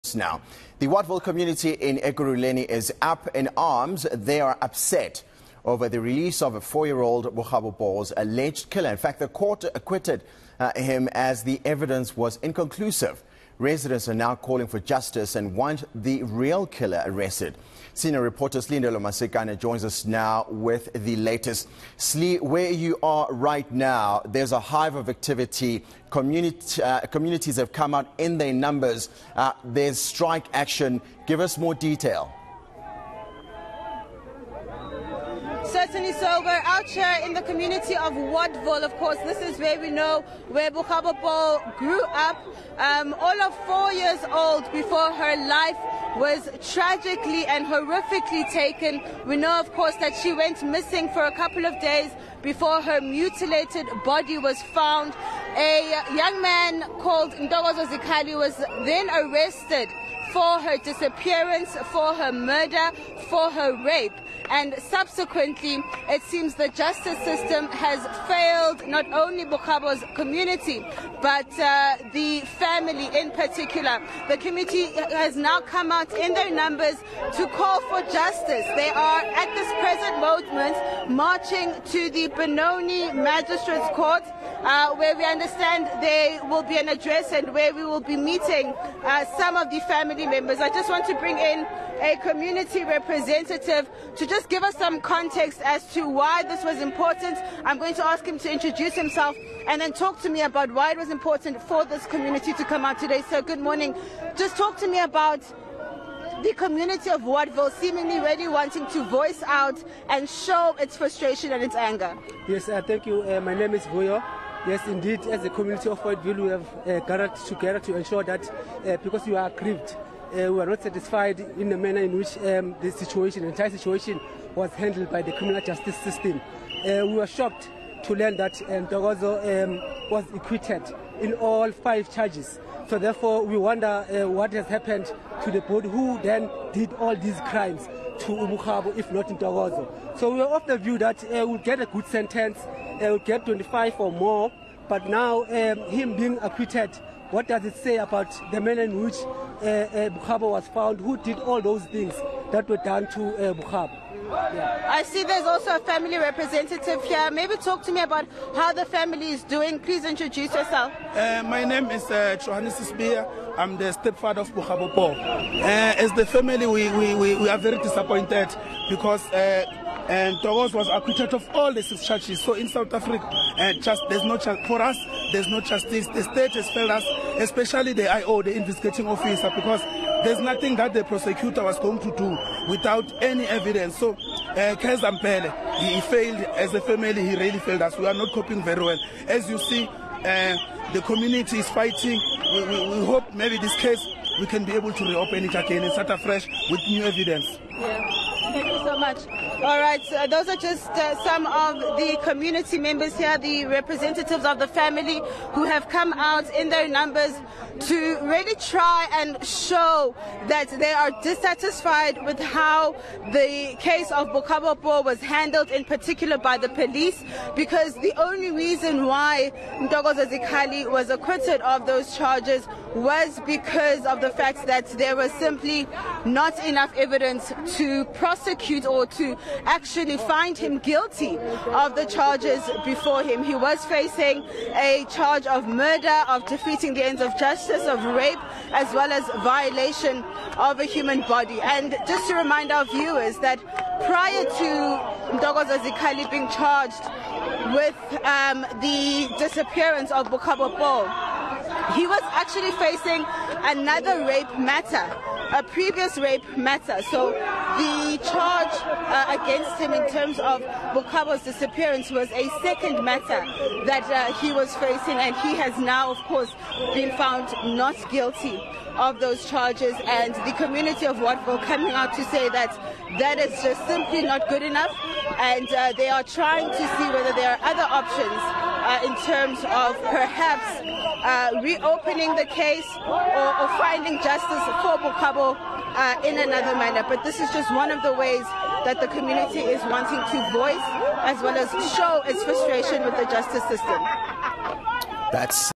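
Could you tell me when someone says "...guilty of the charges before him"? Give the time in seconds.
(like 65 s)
230 s.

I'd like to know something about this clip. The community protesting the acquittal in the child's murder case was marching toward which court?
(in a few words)
Benoni Magistrates Court.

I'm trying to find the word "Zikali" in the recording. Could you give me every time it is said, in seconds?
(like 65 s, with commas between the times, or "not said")
57 s, 220 s, 245 s.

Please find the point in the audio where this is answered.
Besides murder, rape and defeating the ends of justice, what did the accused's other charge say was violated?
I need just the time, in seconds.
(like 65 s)
240 s.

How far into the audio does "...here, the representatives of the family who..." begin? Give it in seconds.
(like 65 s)
203 s.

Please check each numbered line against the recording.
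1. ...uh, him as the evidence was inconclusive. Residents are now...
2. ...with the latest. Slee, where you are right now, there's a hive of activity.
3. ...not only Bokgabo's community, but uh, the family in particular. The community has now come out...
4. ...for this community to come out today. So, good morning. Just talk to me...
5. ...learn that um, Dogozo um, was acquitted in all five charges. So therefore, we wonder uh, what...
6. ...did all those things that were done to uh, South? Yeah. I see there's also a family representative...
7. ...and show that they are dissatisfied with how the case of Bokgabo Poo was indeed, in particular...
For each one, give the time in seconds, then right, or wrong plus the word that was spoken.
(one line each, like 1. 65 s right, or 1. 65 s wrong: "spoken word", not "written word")
1. 10 s right
2. 20 s right
3. 68 s right
4. 101 s right
5. 128 s right
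6. 151 s wrong: "Bokgabo", not "South"
7. 209 s wrong: "handled", not "indeed".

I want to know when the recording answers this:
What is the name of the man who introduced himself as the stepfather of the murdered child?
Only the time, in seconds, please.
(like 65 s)
162 s.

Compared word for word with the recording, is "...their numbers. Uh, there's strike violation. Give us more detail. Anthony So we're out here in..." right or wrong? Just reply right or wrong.
wrong.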